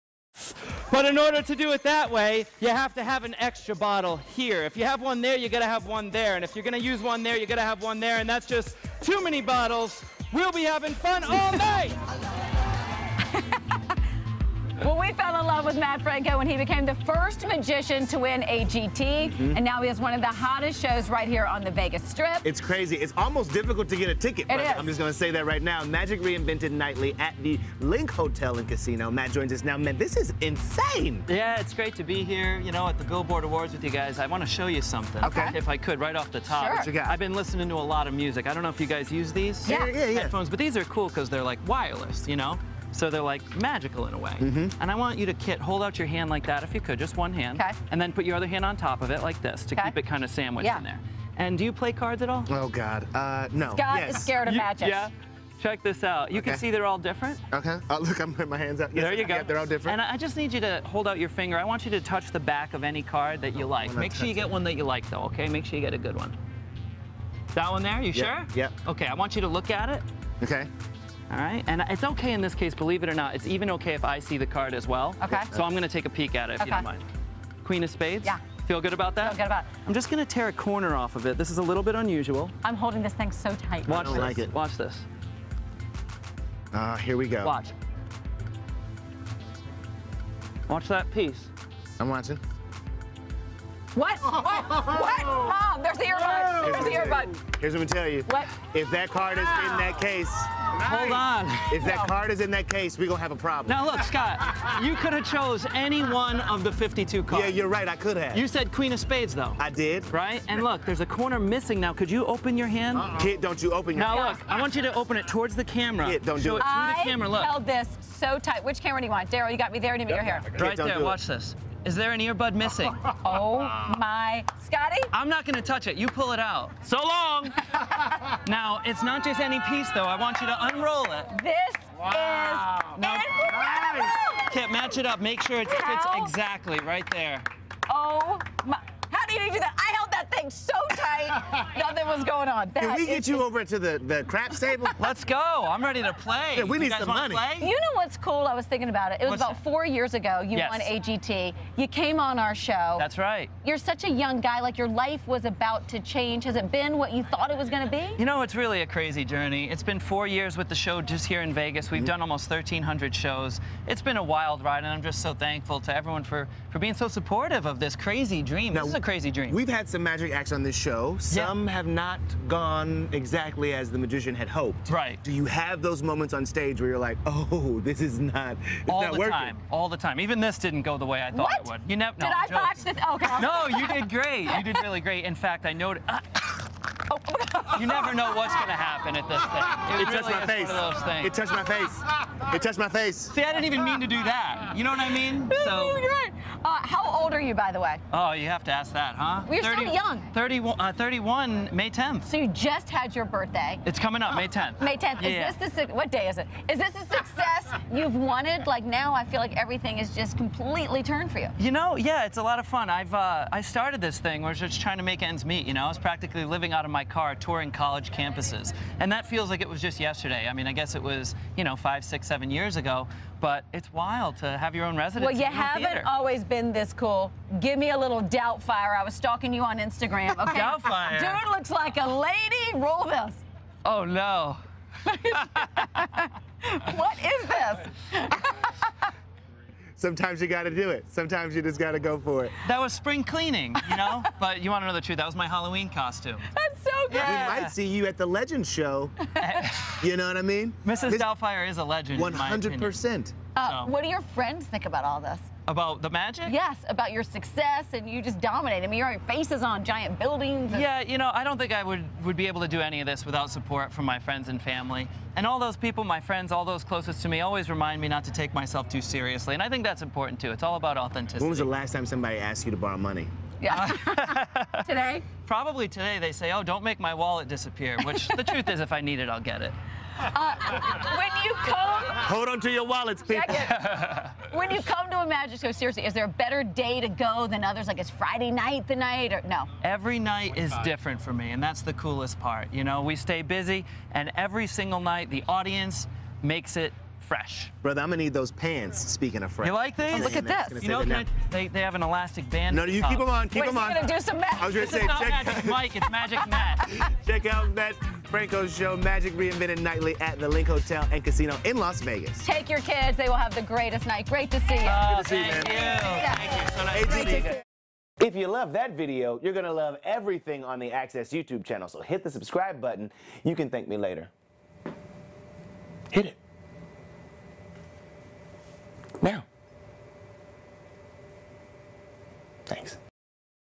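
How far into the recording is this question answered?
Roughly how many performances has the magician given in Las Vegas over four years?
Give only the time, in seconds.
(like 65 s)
162 s.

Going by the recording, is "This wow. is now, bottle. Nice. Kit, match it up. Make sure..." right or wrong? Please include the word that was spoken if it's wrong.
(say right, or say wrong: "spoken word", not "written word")
wrong: "incredible", not "bottle".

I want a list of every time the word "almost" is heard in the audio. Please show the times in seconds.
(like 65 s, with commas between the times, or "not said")
23 s, 162 s.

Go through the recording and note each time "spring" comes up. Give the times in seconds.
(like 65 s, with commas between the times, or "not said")
242 s.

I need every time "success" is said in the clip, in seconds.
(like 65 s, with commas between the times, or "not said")
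207 s, 257 s.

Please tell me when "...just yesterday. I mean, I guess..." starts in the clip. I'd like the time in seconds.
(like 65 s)
219 s.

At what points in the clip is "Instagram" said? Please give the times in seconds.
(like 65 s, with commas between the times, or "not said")
229 s.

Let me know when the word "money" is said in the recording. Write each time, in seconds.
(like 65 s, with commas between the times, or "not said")
147 s, 272 s.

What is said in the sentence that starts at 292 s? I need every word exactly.
You know, we stay busy, and every single night, the audience makes it fresh.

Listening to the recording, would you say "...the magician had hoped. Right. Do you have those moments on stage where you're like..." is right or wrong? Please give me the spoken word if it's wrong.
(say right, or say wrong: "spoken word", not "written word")
right.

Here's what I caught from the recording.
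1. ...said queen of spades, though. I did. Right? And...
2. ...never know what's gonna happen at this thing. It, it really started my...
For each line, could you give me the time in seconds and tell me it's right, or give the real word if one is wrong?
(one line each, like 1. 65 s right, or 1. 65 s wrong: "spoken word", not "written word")
1. 108 s right
2. 187 s wrong: "touched", not "started".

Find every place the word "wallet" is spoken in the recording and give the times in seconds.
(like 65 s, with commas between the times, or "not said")
277 s, 282 s.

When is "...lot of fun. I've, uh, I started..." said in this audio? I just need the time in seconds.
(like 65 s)
212 s.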